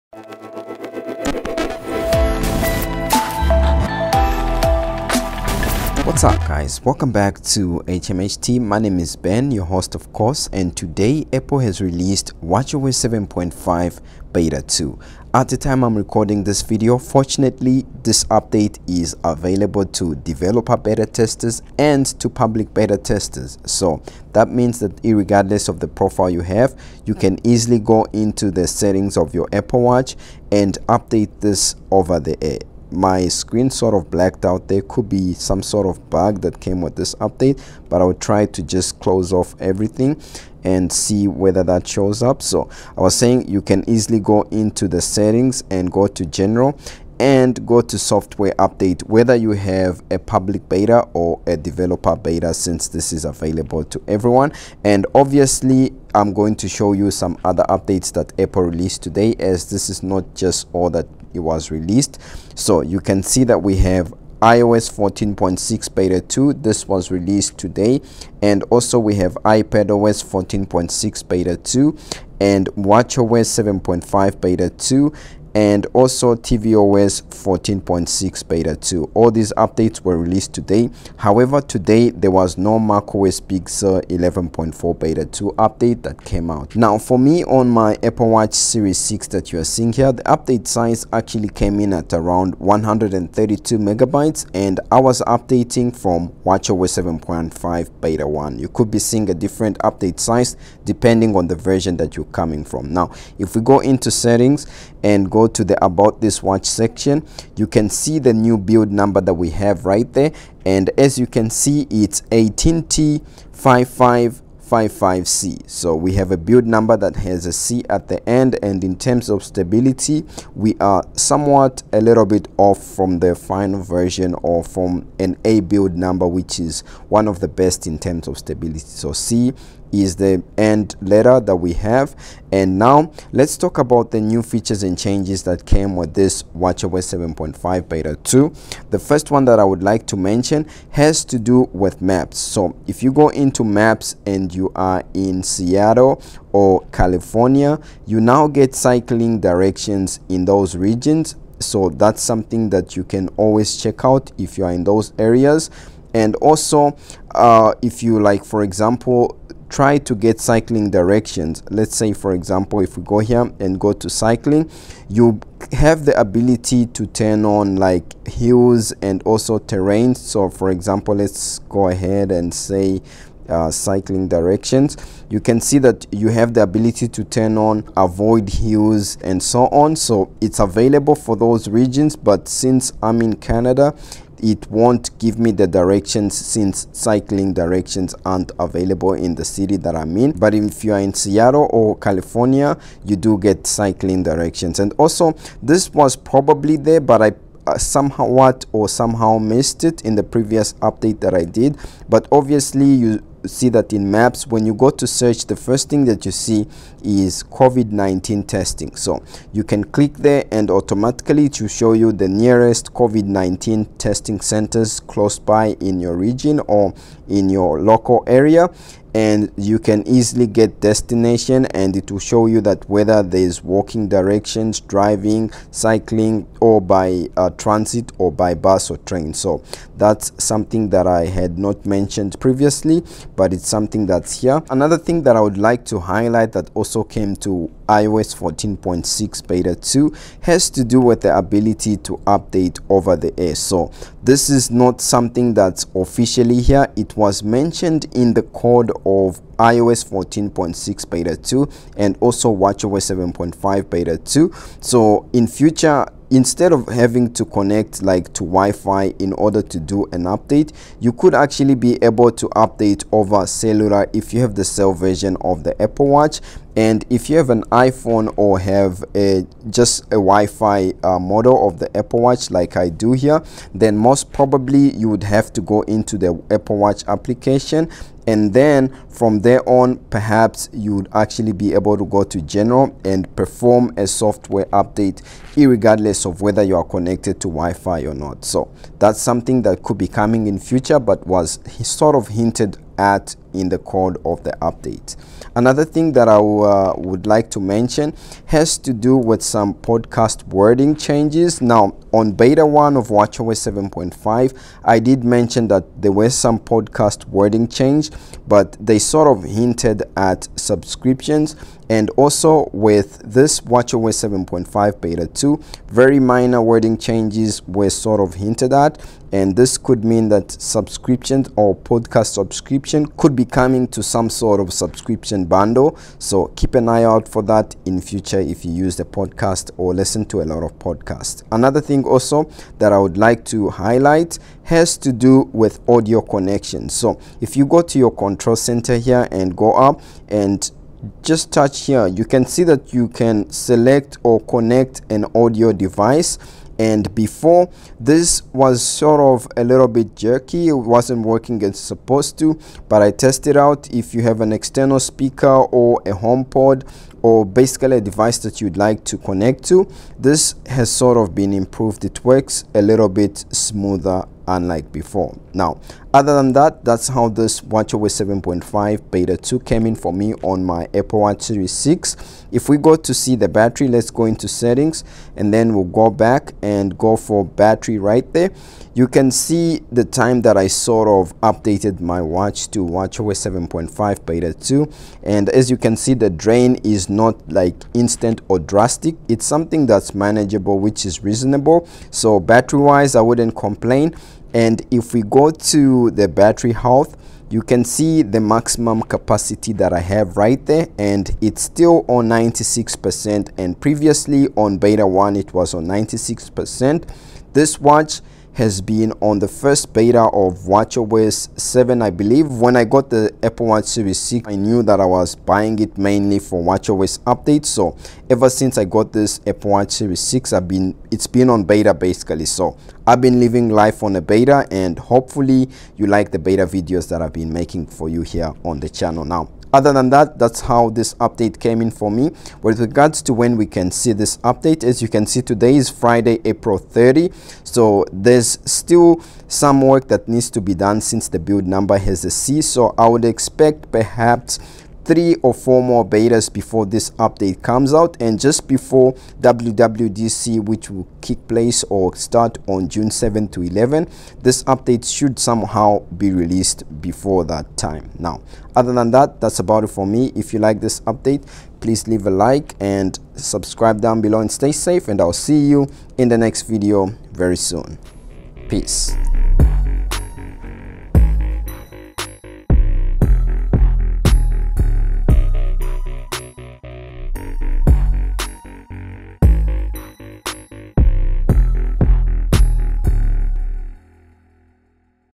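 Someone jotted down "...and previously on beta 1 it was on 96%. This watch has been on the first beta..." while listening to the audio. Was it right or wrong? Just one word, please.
right.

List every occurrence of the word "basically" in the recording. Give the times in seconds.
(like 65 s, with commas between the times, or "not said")
357 s, 421 s.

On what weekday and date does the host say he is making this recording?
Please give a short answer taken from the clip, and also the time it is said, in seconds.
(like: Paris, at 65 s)
Friday April 30, at 435 s.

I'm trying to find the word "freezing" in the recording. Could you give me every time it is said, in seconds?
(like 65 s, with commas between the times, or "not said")
not said.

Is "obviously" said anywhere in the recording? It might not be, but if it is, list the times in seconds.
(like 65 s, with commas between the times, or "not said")
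55 s, 202 s.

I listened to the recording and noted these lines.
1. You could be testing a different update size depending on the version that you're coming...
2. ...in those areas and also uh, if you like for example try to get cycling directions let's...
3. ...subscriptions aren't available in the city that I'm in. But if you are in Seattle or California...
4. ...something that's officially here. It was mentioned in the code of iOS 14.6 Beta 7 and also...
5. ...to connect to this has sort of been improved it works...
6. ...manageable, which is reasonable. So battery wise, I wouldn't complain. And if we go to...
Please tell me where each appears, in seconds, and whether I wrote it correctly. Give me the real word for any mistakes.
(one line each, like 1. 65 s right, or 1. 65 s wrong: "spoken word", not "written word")
1. 98 s wrong: "seeing", not "testing"
2. 154 s right
3. 187 s wrong: "directions", not "subscriptions"
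4. 245 s wrong: "2", not "7"
5. 359 s right
6. 390 s right.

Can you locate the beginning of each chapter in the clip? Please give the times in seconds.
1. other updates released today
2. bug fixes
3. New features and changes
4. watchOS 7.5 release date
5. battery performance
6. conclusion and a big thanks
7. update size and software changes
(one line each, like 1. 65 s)
1. 54 s
2. 331 s
3. 132 s
4. 432 s
5. 372 s
6. 458 s
7. 87 s.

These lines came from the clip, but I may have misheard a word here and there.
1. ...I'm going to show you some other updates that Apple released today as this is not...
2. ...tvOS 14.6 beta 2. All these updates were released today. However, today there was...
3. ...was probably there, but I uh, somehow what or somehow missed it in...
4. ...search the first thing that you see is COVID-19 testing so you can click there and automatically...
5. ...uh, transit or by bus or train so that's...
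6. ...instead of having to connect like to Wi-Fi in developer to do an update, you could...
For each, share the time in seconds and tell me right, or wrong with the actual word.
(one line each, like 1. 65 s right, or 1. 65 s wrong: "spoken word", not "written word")
1. 56 s right
2. 76 s right
3. 195 s right
4. 205 s right
5. 227 s right
6. 256 s wrong: "order", not "developer".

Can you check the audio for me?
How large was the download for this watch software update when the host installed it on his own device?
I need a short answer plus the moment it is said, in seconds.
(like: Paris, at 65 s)
132 megabytes, at 92 s.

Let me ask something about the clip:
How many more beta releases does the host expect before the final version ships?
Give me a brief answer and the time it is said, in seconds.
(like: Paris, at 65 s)
three or four, at 445 s.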